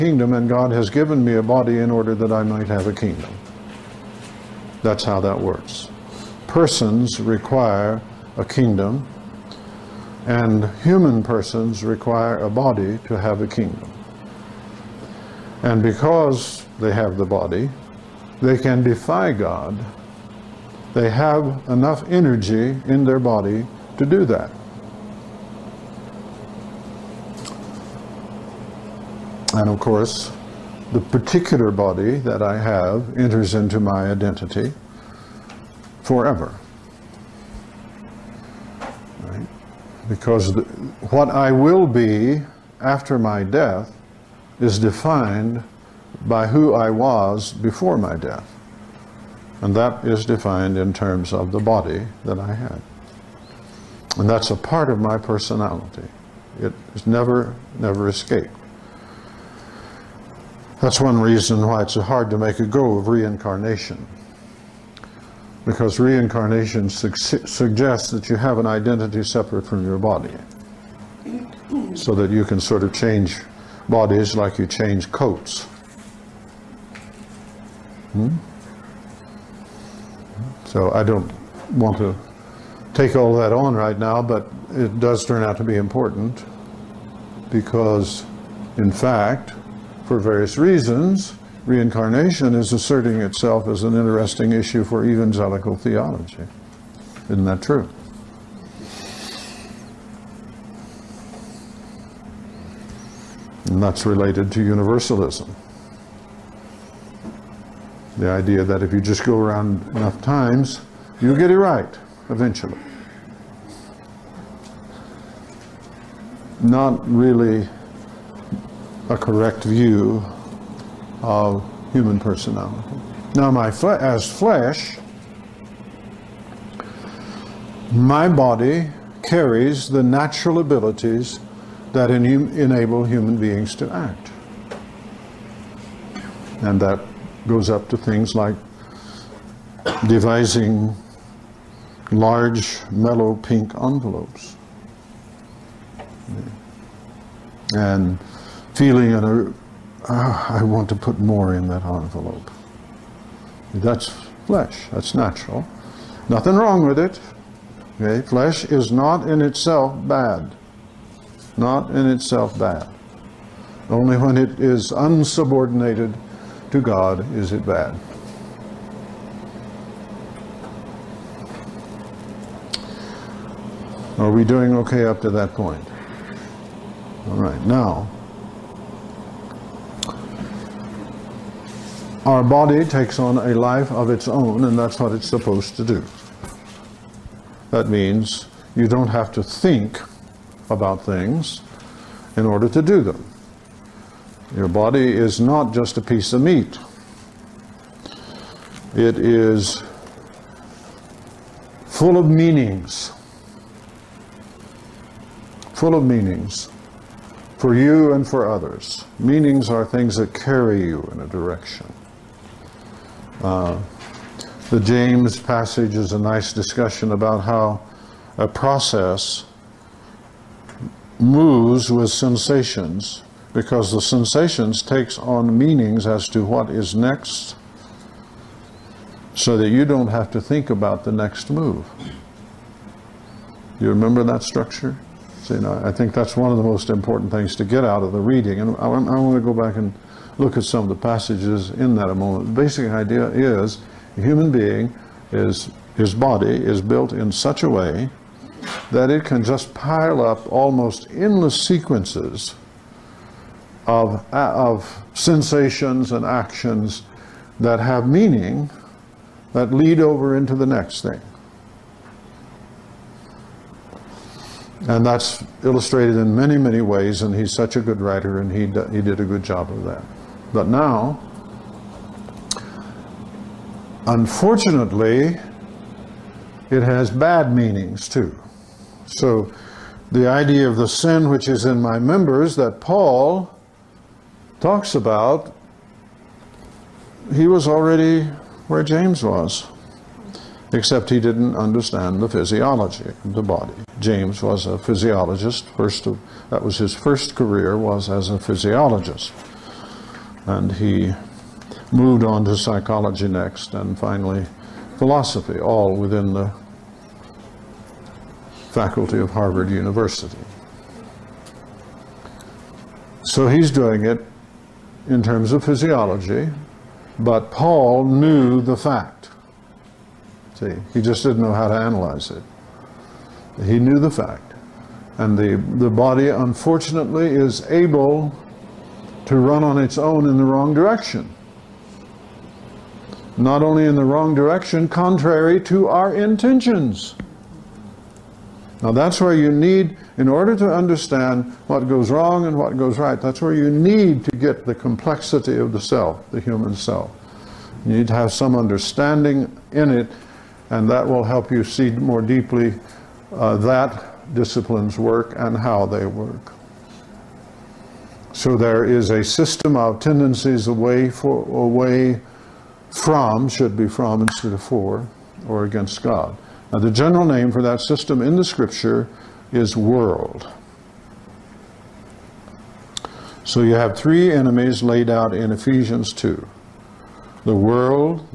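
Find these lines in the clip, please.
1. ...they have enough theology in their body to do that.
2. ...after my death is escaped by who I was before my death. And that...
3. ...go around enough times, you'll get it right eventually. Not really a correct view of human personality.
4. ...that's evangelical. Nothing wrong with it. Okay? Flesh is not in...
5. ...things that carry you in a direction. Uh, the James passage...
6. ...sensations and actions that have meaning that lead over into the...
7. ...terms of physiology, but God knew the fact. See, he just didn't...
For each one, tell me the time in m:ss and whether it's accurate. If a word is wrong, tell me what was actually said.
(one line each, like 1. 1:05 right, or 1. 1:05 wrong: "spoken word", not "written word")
1. 0:20 wrong: "energy", not "theology"
2. 0:42 wrong: "defined", not "escaped"
3. 1:49 right
4. 2:34 wrong: "natural", not "evangelical"
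5. 3:29 right
6. 4:15 right
7. 5:15 wrong: "Paul", not "God".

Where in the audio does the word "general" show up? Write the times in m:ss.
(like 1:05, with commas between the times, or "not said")
6:06.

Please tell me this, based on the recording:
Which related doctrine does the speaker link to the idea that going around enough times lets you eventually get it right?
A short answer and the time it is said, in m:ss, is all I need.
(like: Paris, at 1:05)
Universalism, at 1:44.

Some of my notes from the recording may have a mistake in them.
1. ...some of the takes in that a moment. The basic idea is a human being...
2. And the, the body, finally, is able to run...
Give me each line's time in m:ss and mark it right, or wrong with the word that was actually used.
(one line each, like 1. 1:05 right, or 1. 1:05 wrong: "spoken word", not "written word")
1. 4:00 wrong: "passages", not "takes"
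2. 5:25 wrong: "unfortunately", not "finally".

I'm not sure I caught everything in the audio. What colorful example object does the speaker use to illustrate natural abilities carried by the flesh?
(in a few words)
large, mellow pink envelopes.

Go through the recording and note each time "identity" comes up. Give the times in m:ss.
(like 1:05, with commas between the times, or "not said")
0:34, 1:08.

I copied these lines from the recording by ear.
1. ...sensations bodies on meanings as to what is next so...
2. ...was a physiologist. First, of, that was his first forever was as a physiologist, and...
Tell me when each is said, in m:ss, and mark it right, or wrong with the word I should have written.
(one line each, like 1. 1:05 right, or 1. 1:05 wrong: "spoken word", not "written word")
1. 3:44 wrong: "takes", not "bodies"
2. 4:54 wrong: "career", not "forever".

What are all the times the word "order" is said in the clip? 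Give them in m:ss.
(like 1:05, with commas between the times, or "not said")
0:01, 3:12, 5:40.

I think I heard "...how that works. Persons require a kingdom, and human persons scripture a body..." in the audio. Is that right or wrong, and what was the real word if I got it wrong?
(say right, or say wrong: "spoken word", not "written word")
wrong: "require", not "scripture".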